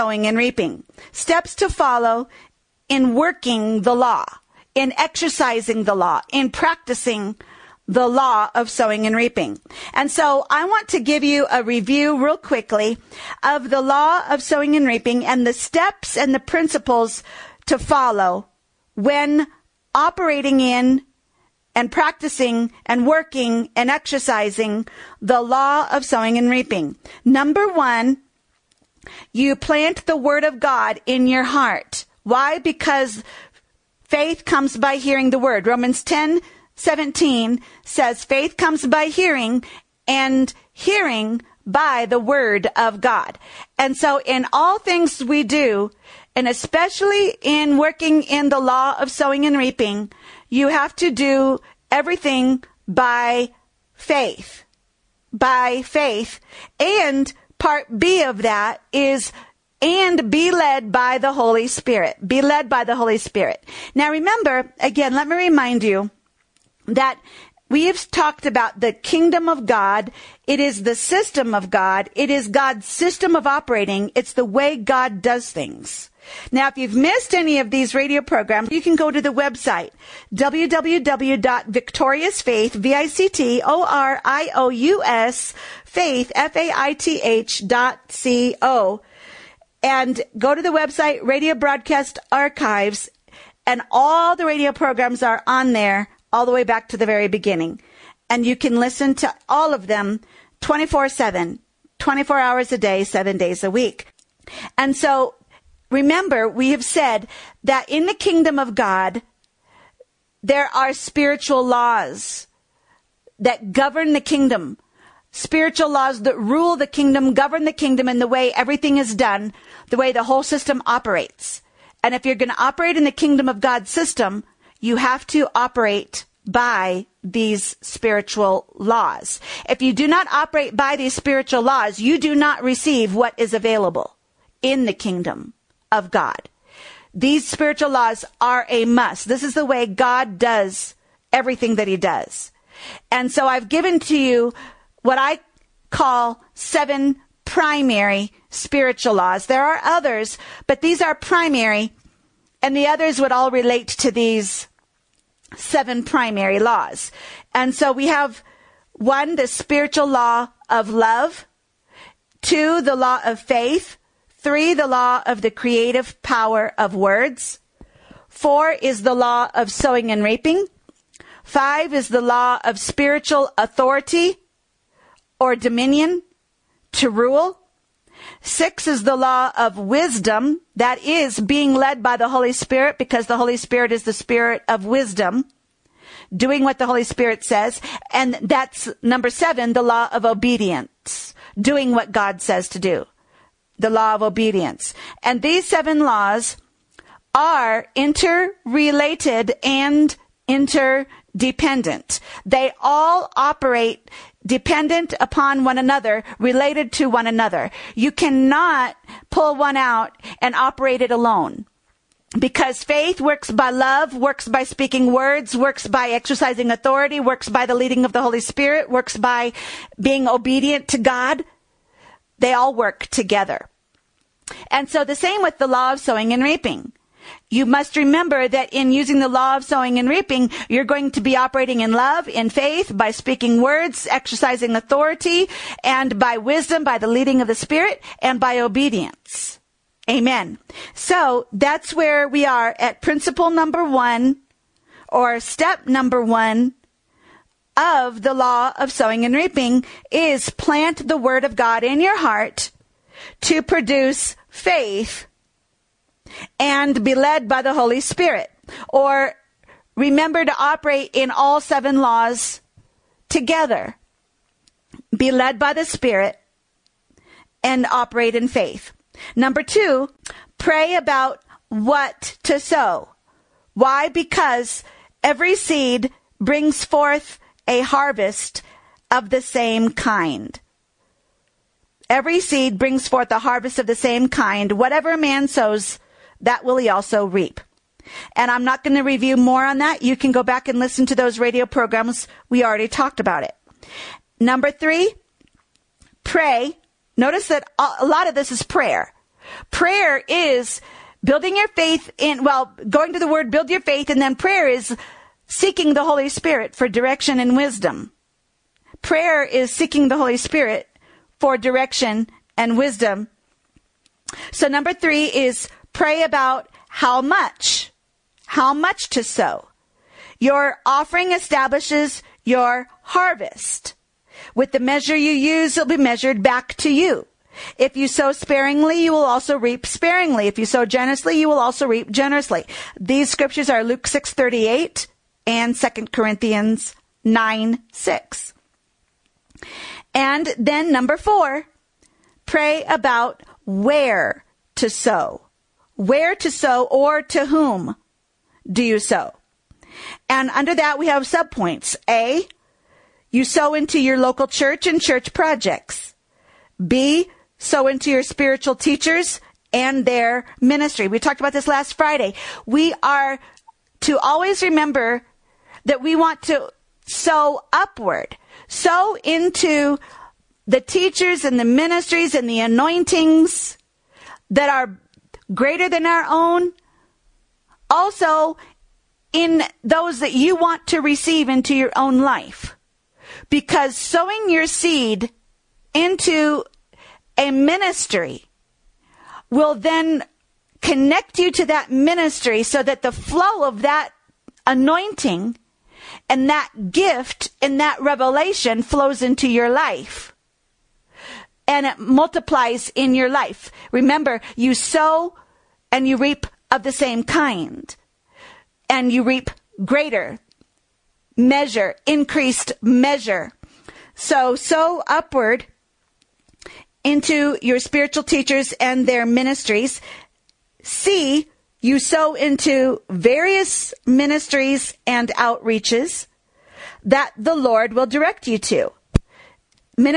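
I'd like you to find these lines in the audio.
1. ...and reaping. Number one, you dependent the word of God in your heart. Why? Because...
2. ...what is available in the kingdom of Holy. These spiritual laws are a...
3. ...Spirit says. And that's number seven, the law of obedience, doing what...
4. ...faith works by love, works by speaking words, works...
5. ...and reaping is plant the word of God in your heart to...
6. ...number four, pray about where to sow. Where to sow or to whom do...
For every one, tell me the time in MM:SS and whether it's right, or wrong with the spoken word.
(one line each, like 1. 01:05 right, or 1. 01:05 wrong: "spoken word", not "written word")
1. 00:26 wrong: "plant", not "dependent"
2. 02:13 wrong: "God", not "Holy"
3. 03:07 right
4. 03:32 right
5. 04:09 right
6. 05:40 right.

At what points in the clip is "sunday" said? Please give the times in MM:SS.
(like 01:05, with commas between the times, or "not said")
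not said.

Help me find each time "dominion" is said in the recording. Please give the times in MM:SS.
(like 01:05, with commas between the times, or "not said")
02:55.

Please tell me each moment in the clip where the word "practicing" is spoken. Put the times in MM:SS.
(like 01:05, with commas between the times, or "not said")
00:06, 00:21.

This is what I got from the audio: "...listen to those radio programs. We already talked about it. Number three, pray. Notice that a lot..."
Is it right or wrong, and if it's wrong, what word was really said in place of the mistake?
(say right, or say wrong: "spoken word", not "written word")
right.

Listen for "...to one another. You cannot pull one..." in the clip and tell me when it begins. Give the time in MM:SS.
03:26.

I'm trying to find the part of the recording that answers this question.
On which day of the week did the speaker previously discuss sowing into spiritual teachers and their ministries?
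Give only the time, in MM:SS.
06:01.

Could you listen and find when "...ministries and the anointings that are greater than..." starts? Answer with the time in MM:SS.
06:11.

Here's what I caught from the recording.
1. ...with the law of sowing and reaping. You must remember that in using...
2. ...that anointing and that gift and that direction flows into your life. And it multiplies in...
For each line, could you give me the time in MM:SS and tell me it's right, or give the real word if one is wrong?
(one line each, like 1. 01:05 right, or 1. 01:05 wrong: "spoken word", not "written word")
1. 03:45 right
2. 06:33 wrong: "revelation", not "direction".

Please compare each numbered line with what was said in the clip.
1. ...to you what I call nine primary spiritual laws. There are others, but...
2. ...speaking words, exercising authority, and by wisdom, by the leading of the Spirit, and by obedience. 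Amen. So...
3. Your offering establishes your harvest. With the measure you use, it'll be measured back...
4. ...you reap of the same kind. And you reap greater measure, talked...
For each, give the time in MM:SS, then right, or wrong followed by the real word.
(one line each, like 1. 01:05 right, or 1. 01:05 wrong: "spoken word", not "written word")
1. 02:23 wrong: "seven", not "nine"
2. 03:53 right
3. 05:20 right
4. 06:46 wrong: "increased", not "talked".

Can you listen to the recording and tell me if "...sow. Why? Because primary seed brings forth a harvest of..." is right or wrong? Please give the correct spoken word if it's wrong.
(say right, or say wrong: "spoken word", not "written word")
wrong: "every", not "primary".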